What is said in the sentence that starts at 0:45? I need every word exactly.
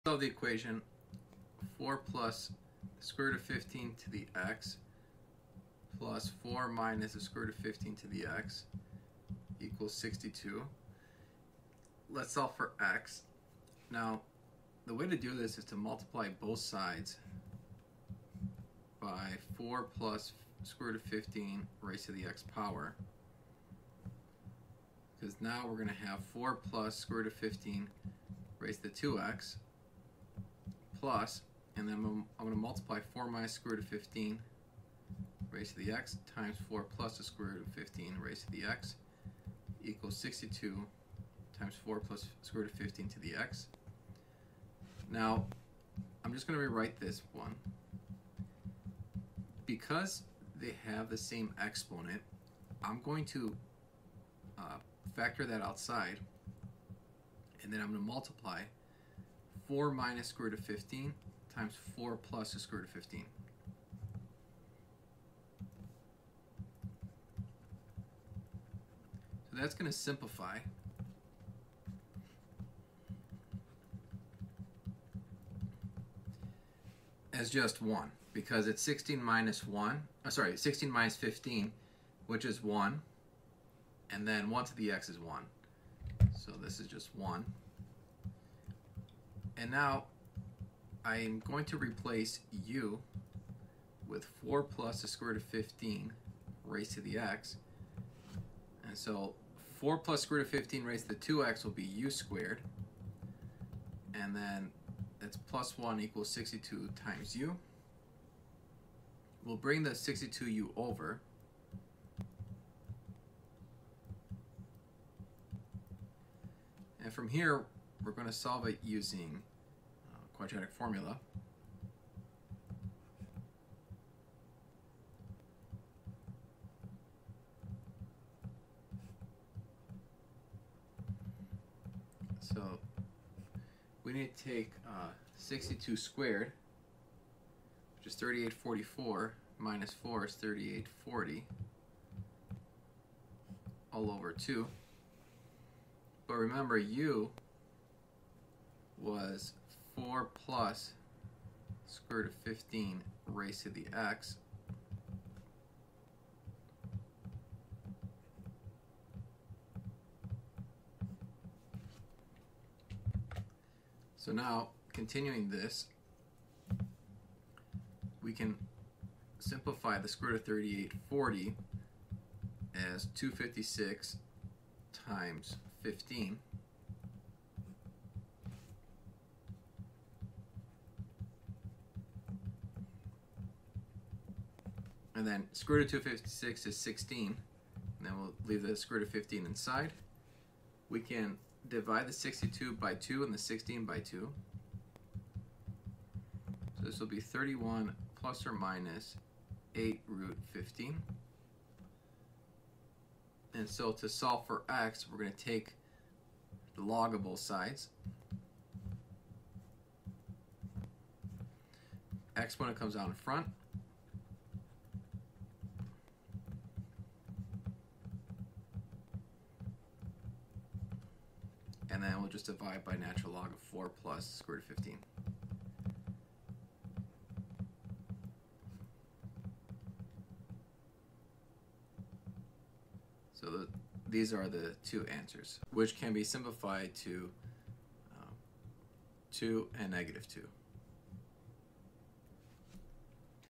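Now, I'm just going to rewrite this one.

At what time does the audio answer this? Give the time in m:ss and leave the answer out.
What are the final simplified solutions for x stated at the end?
3:59.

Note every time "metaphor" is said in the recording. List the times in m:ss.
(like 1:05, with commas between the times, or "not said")
not said.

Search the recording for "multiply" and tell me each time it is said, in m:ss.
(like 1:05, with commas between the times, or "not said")
0:15, 0:32, 0:58.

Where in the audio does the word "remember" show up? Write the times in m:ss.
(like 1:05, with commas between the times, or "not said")
2:26.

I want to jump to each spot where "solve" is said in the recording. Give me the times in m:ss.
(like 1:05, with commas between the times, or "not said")
0:00, 0:12, 1:58, 3:24.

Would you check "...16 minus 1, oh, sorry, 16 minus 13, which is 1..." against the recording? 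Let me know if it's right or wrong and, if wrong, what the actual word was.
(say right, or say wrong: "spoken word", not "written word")
wrong: "15", not "13".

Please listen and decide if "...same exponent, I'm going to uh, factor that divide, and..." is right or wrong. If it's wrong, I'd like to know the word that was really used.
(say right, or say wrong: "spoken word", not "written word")
wrong: "outside", not "divide".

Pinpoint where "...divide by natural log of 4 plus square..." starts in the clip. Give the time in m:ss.
3:42.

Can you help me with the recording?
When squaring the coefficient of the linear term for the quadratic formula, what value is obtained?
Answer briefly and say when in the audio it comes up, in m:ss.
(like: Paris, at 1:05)
3844, at 2:18.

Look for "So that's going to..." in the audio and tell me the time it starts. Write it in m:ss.
1:09.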